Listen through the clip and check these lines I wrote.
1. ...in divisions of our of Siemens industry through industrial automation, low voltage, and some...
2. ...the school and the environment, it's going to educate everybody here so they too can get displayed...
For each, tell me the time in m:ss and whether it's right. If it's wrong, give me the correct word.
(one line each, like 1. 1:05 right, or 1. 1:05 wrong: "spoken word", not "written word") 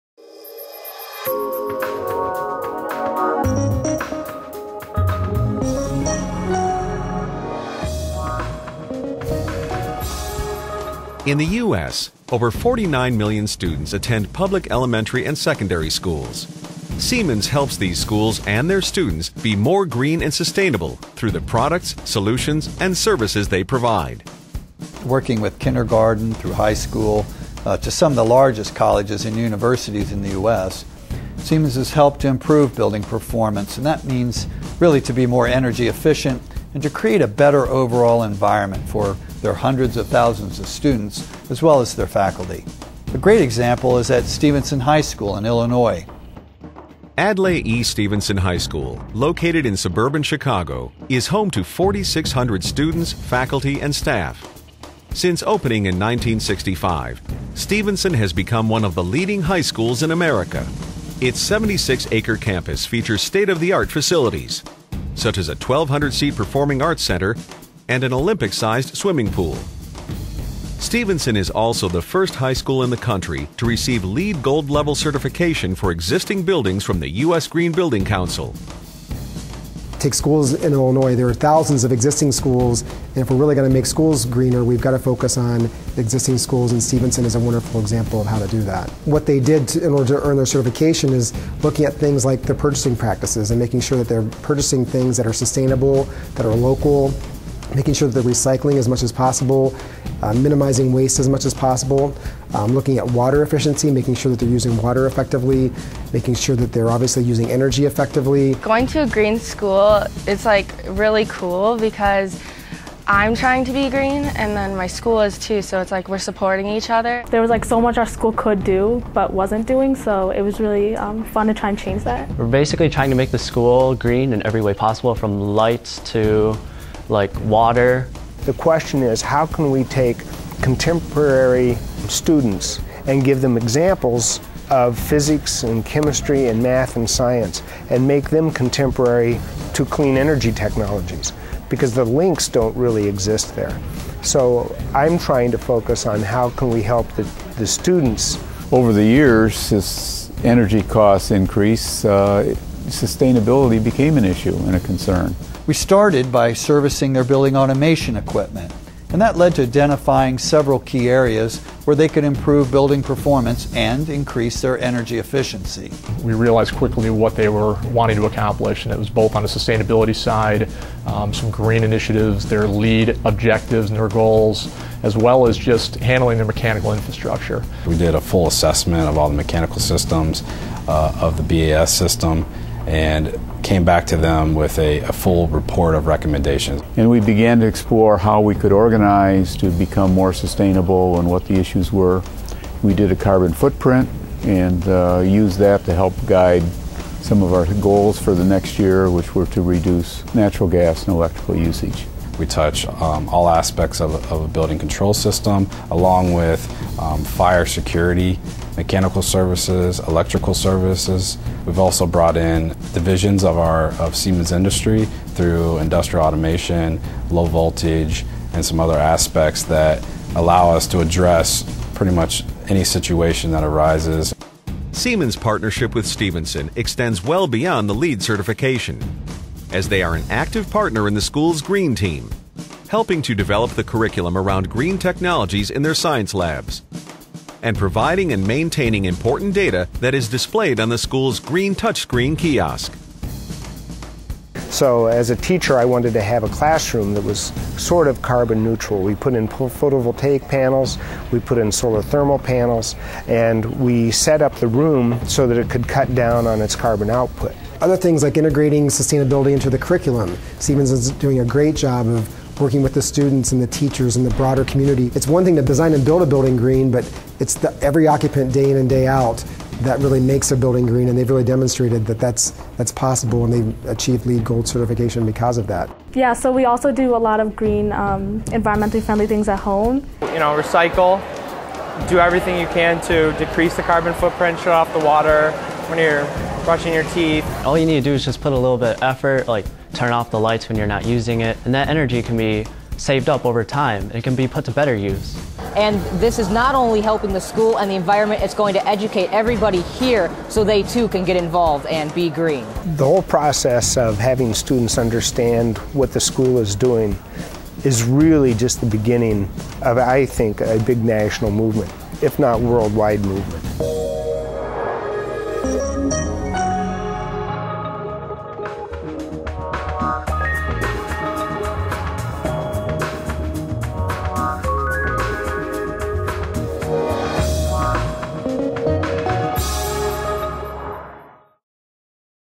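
1. 3:32 right
2. 4:57 wrong: "involved", not "displayed".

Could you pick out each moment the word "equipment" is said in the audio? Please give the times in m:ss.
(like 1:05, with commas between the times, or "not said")
2:38.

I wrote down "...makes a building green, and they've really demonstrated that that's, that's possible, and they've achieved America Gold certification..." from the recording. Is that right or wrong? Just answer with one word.
wrong.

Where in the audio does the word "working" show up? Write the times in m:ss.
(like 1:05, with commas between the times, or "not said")
0:25, 4:22.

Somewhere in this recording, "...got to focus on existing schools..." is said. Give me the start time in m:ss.
1:24.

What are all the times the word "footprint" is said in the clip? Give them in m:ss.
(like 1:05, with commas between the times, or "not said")
3:13, 4:44.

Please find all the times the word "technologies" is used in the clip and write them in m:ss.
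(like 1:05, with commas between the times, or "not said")
2:20, 3:54.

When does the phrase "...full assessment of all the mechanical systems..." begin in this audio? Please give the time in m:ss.
2:58.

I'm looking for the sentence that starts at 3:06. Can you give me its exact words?
And we began to explore how we could organize to become more sustainable and what the issues were.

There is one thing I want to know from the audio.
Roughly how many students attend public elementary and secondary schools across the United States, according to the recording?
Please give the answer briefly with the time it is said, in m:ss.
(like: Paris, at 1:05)
over 49 million, at 0:12.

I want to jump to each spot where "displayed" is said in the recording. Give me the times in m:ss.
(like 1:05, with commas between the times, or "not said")
4:00.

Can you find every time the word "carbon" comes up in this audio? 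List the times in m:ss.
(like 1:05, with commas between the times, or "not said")
3:13, 4:08, 4:16, 4:43.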